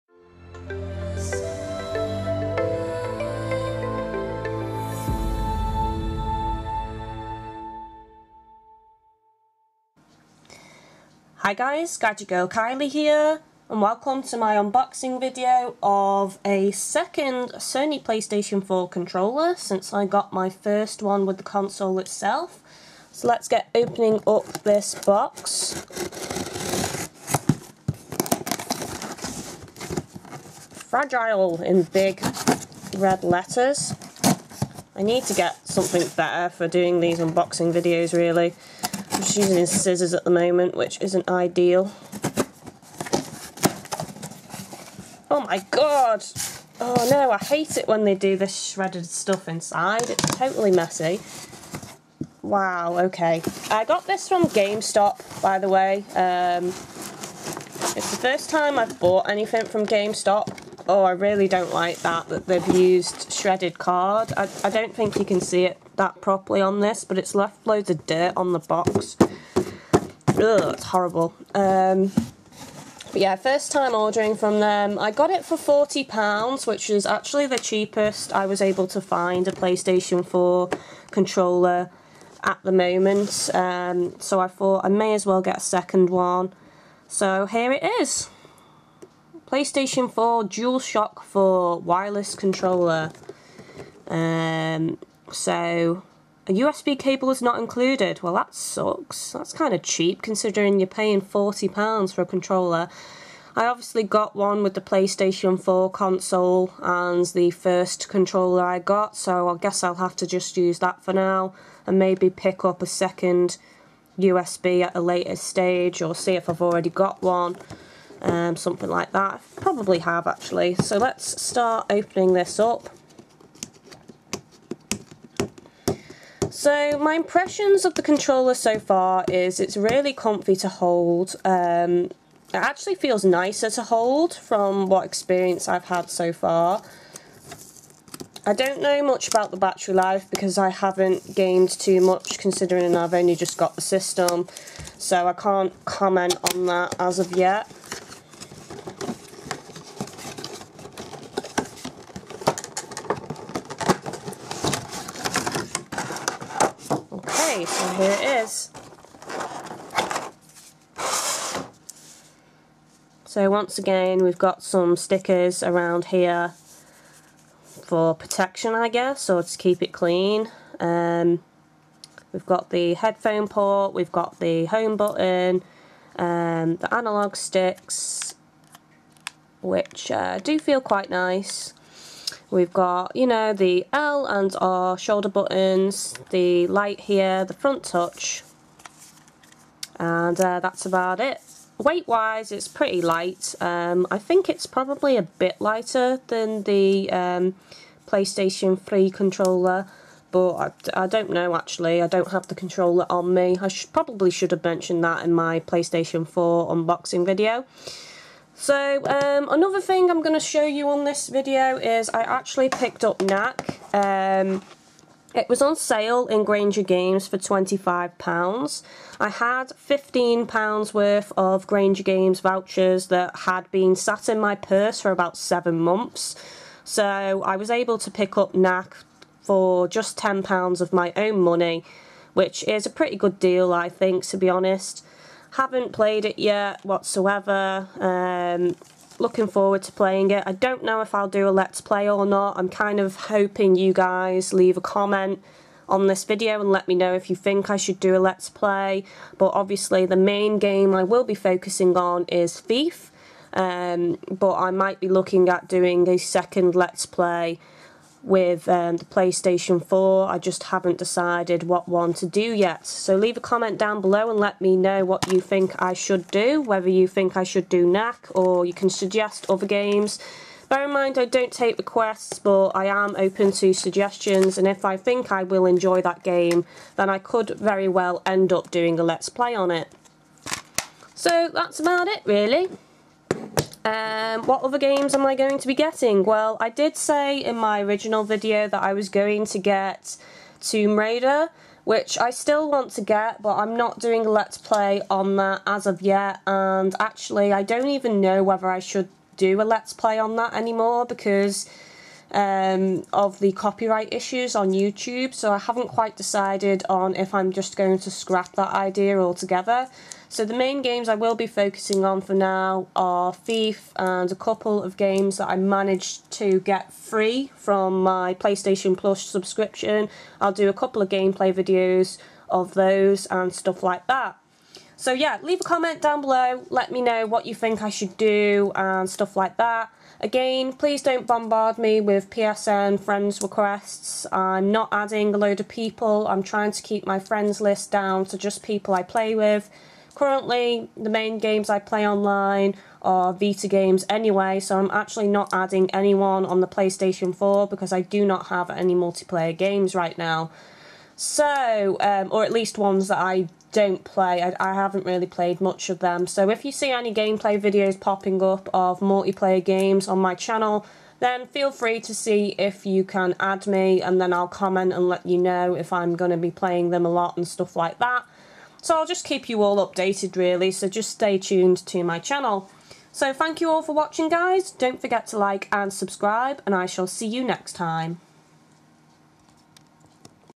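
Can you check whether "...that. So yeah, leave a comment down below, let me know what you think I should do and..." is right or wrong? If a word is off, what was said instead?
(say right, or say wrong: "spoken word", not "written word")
right.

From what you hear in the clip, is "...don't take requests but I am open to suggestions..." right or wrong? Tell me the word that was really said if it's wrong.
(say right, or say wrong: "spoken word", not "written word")
right.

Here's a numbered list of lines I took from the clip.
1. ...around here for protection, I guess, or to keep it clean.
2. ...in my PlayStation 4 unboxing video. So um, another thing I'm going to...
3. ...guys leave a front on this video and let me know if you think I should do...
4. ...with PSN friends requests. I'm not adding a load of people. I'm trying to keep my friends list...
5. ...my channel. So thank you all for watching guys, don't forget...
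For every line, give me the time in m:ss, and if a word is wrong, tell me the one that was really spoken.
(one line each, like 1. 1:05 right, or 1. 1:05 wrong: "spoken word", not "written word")
1. 2:45 right
2. 3:25 right
3. 4:03 wrong: "comment", not "front"
4. 5:31 right
5. 6:12 right.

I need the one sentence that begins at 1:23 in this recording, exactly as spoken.
Um, so I thought I may as well get a second one.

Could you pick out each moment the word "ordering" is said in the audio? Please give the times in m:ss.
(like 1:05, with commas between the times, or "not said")
1:13.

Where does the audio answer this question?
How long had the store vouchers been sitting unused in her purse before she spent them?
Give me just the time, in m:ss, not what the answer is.
3:45.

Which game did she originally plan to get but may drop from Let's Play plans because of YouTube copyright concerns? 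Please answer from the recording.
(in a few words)
Tomb Raider.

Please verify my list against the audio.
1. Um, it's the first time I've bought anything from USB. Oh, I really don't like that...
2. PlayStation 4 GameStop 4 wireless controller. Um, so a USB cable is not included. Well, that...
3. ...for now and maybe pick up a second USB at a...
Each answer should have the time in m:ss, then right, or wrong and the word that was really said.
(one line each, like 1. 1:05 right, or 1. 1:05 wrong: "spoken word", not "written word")
1. 0:56 wrong: "GameStop", not "USB"
2. 1:29 wrong: "DualShock", not "GameStop"
3. 1:51 right.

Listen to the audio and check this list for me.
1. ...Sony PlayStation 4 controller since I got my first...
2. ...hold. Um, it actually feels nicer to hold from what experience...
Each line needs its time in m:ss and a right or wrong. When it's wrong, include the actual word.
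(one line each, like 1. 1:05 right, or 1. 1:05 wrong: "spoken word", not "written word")
1. 0:17 right
2. 2:10 right.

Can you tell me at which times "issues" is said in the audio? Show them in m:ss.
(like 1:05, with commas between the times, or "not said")
5:04.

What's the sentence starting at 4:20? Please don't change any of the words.
I just haven't decided what one to do yet.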